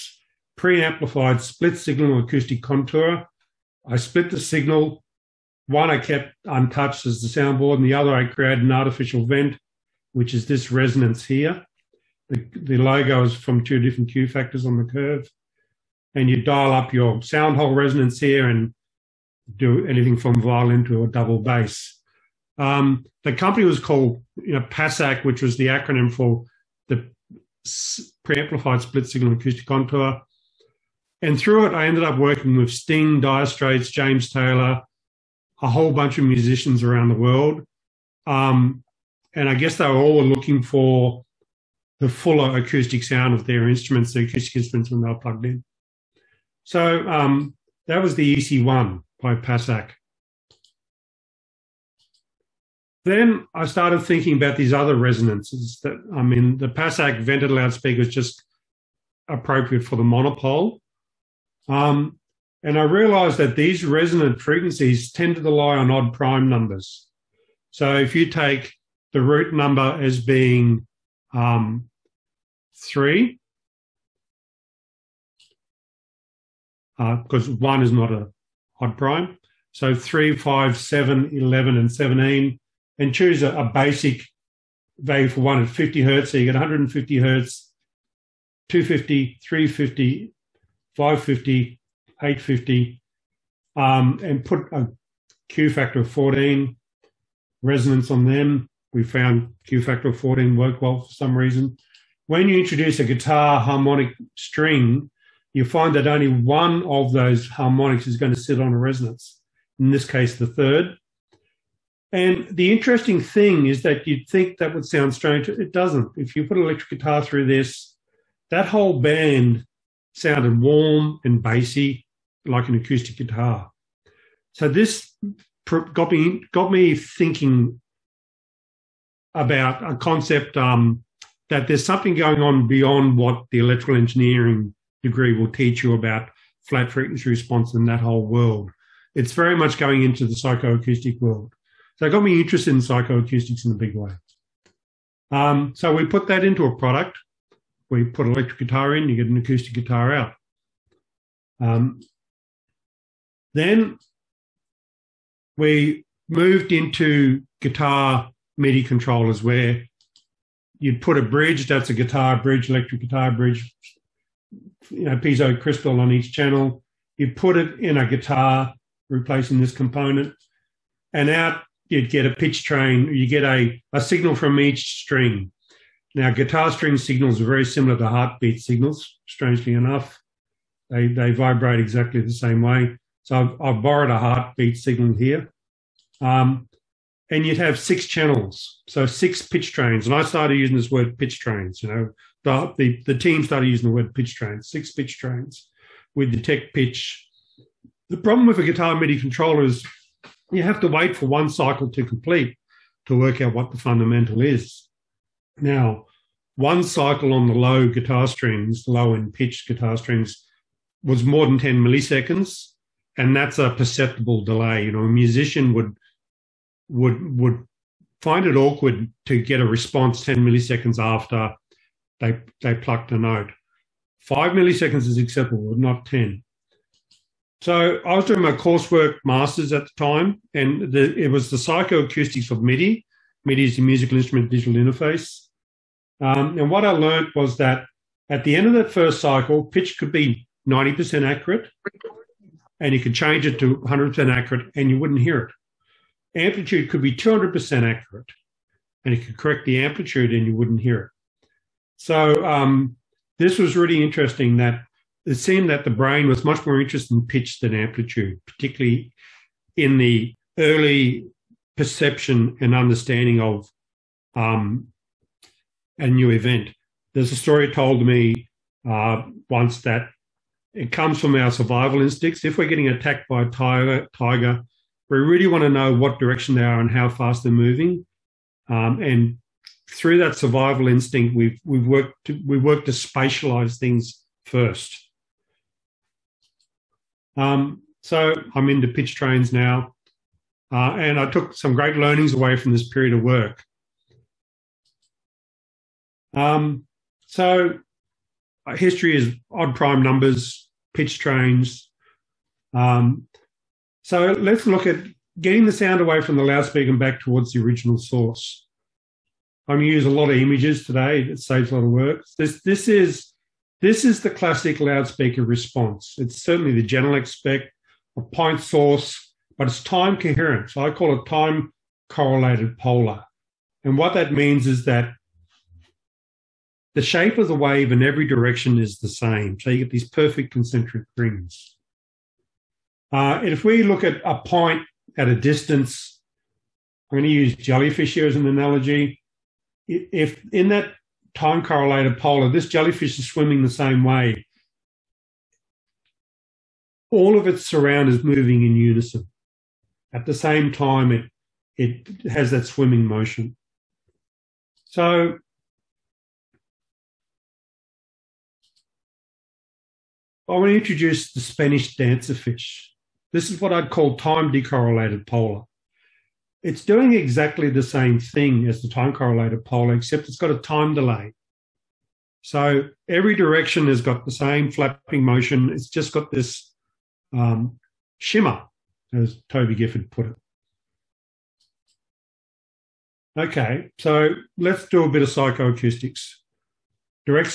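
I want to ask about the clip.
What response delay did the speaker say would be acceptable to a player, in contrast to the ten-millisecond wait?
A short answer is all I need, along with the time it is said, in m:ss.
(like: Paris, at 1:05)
5 milliseconds, at 3:44.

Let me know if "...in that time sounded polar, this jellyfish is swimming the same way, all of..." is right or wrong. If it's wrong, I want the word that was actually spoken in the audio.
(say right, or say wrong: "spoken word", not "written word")
wrong: "correlated", not "sounded".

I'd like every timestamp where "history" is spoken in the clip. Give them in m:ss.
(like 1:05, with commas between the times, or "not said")
4:58.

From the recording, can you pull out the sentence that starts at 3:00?
They, they vibrate exactly the same way.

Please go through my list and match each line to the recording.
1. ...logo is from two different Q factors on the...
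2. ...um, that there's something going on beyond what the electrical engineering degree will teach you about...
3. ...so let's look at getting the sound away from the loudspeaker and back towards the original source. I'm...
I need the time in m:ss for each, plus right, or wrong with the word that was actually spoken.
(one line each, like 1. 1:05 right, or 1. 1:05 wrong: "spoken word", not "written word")
1. 0:12 right
2. 2:10 right
3. 5:04 right.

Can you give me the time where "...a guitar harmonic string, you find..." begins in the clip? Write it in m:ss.
1:42.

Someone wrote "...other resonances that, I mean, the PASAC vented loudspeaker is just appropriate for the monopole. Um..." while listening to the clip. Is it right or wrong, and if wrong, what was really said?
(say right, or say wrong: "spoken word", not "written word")
right.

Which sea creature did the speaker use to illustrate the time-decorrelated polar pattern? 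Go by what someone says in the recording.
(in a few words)
Spanish dancer fish.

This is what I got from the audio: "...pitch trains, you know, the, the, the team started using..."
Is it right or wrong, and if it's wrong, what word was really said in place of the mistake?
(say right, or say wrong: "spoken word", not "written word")
right.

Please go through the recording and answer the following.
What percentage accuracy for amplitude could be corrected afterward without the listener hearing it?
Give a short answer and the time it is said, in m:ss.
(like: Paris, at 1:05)
200%, at 4:07.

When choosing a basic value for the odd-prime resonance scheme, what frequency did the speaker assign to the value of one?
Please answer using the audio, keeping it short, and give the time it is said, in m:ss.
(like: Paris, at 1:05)
50 Hz, at 1:25.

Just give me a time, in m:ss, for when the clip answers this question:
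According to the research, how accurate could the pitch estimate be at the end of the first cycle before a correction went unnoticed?
4:00.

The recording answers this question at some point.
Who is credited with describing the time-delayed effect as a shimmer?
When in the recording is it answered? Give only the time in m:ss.
6:19.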